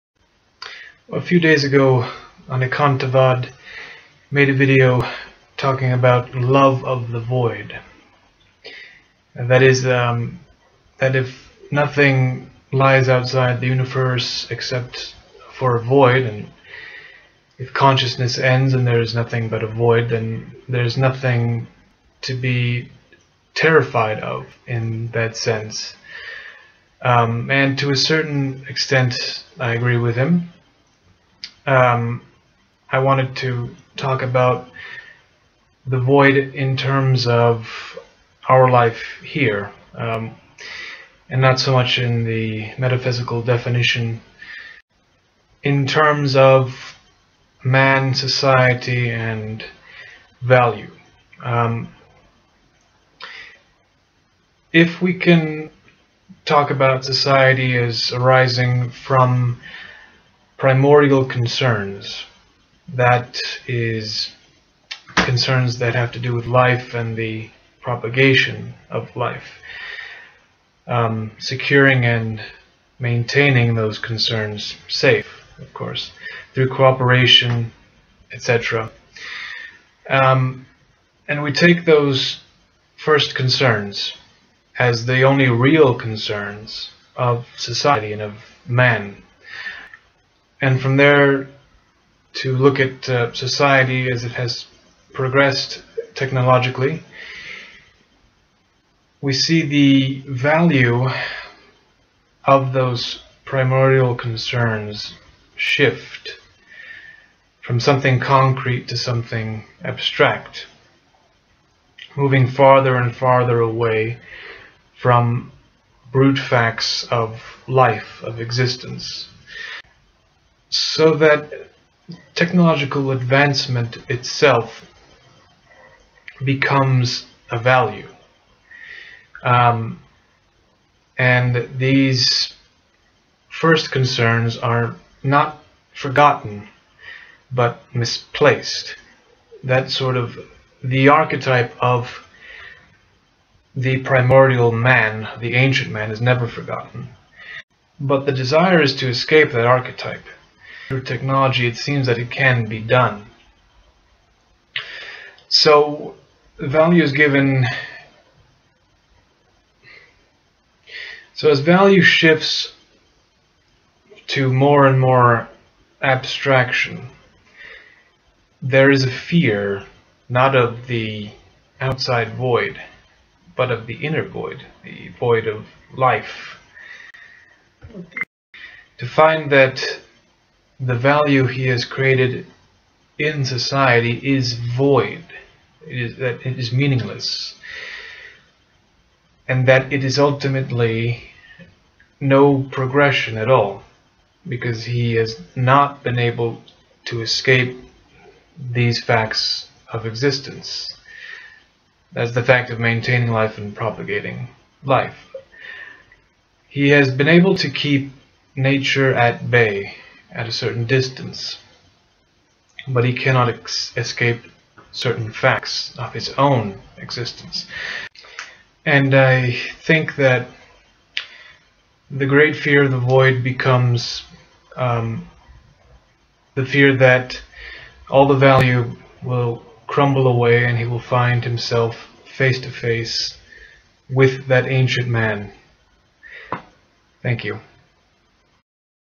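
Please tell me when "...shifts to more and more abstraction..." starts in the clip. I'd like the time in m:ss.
2:42.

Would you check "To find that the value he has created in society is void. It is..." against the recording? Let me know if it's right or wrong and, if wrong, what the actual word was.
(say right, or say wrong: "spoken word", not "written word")
right.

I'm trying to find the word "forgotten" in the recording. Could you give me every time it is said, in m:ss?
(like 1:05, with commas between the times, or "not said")
2:15, 2:26.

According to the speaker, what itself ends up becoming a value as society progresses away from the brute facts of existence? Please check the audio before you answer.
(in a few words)
technological advancement.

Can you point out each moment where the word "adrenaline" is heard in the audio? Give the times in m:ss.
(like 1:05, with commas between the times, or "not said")
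not said.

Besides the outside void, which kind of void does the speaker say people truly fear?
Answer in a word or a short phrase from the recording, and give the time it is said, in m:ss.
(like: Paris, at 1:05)
the inner void, at 2:53.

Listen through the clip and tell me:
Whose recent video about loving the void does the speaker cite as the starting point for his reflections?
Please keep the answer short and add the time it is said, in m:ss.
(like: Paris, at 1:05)
Anekantavad, at 0:02.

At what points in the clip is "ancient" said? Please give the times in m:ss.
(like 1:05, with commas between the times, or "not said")
2:25, 3:54.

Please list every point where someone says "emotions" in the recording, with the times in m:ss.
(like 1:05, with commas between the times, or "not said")
not said.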